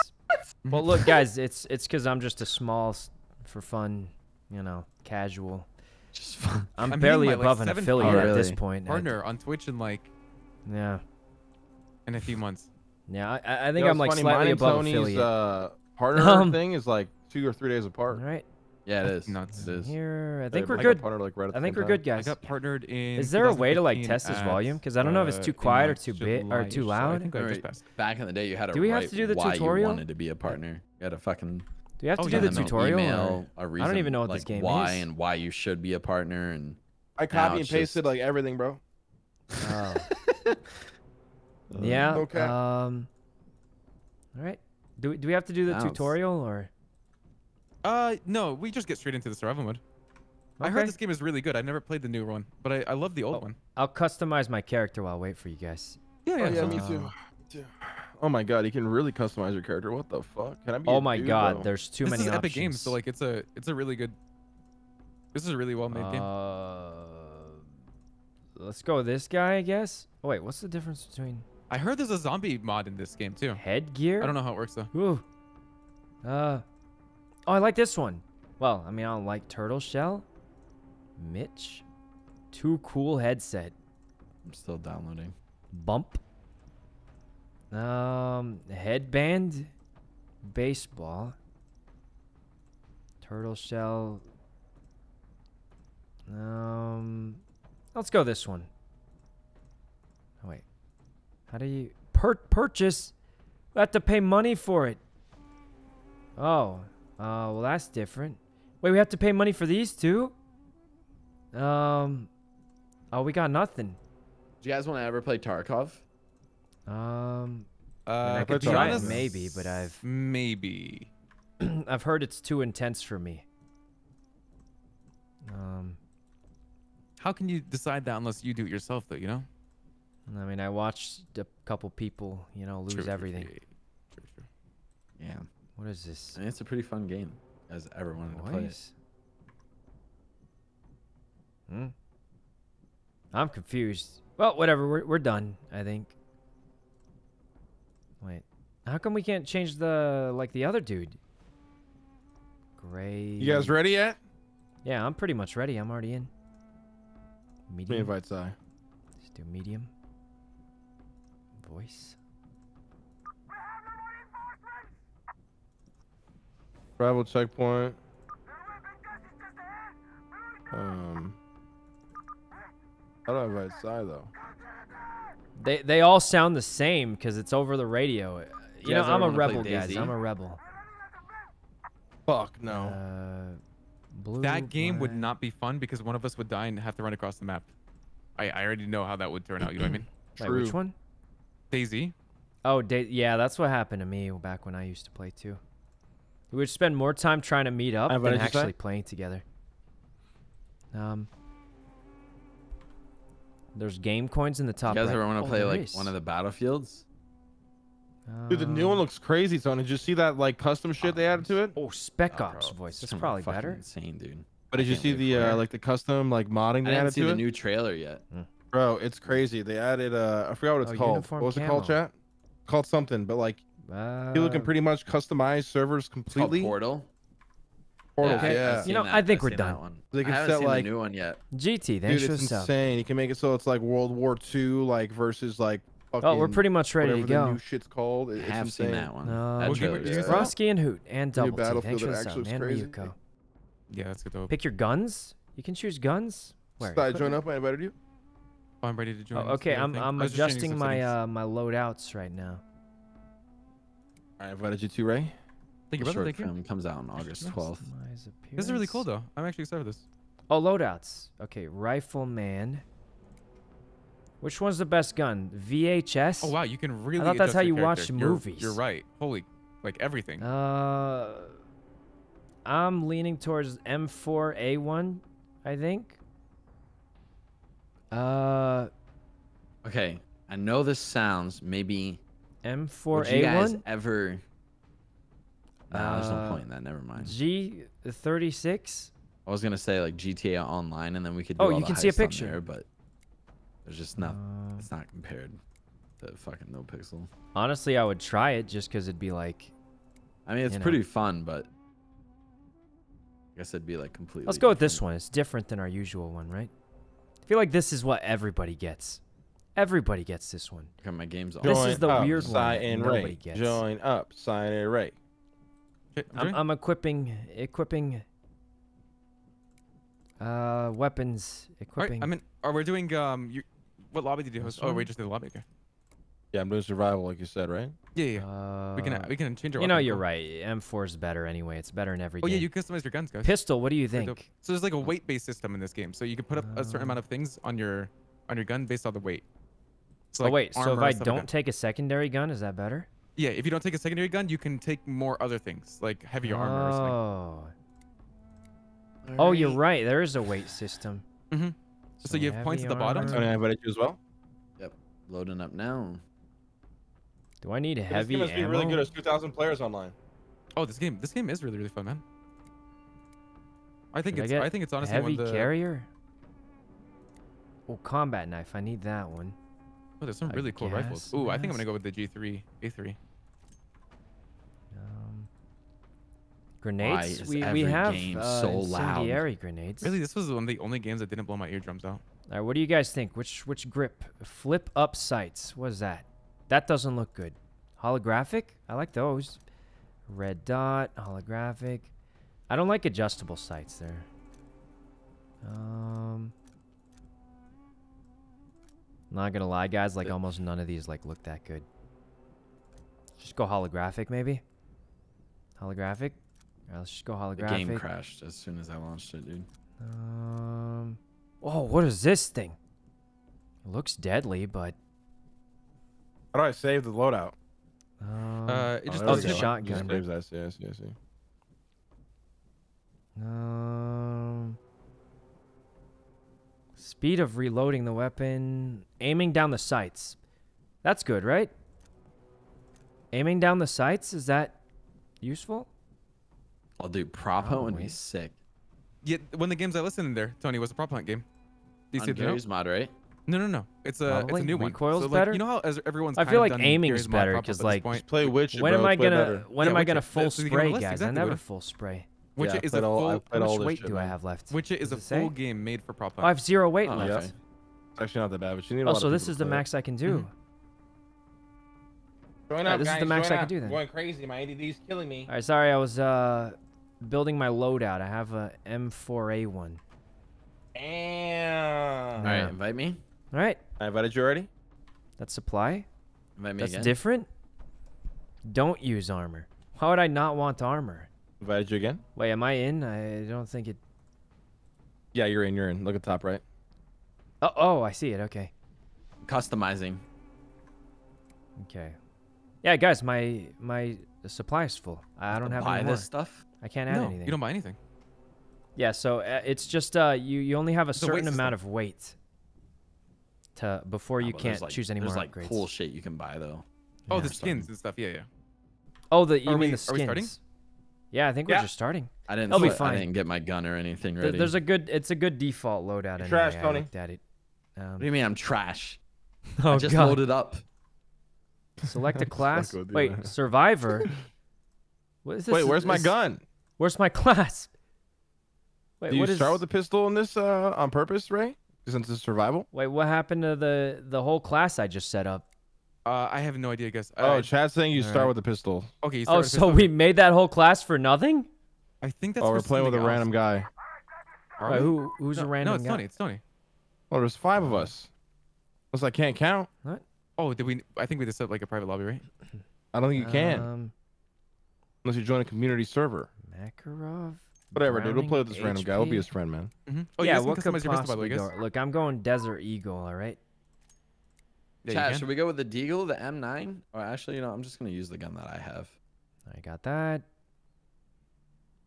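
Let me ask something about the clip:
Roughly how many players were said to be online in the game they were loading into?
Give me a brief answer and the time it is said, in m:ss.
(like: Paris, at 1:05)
2,000, at 5:59.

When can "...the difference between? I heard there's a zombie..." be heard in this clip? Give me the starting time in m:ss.
1:10.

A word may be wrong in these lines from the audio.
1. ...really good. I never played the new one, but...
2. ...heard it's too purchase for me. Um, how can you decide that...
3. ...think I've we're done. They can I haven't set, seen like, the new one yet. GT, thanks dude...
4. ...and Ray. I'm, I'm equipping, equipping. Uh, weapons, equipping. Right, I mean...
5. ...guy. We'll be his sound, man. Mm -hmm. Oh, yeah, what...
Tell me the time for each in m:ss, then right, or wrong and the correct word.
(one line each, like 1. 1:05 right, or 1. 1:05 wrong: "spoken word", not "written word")
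1. 0:51 right
2. 2:02 wrong: "intense", not "purchase"
3. 3:49 right
4. 5:14 right
5. 9:19 wrong: "friend", not "sound".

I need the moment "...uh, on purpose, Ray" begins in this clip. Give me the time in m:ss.
8:50.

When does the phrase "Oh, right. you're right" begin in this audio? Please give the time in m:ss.
5:49.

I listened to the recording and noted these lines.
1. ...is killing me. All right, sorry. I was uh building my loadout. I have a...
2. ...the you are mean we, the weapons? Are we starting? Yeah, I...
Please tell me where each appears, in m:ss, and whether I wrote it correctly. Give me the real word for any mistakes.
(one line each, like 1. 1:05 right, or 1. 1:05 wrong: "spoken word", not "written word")
1. 7:44 right
2. 8:29 wrong: "skins", not "weapons".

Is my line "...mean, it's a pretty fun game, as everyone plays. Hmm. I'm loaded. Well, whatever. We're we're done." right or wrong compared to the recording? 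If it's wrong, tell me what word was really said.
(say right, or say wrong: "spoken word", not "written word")
wrong: "confused", not "loaded".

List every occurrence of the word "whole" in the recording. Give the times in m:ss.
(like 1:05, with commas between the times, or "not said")
8:54, 9:00.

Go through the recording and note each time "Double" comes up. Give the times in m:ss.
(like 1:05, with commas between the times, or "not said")
4:01.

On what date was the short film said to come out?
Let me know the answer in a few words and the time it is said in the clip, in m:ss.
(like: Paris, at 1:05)
August 12th, at 4:17.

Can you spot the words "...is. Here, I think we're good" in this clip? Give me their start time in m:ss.
0:19.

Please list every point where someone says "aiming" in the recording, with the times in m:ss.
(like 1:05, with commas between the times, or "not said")
7:09, 7:13, 7:26.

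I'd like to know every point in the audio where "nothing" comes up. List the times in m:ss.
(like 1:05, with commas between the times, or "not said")
1:53, 9:01.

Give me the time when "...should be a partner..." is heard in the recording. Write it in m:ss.
0:35.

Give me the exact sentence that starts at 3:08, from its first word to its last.
I I already know how that would turn out.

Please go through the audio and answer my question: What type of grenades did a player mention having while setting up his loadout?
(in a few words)
Incendiary grenades.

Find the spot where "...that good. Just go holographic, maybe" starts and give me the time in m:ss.
6:41.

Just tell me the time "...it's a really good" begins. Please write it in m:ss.
1:03.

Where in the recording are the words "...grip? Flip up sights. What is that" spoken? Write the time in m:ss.
6:23.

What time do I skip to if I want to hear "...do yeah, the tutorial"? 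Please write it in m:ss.
0:32.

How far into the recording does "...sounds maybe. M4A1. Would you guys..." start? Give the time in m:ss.
4:40.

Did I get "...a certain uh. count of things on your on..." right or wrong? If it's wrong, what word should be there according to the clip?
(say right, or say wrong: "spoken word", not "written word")
wrong: "amount", not "count".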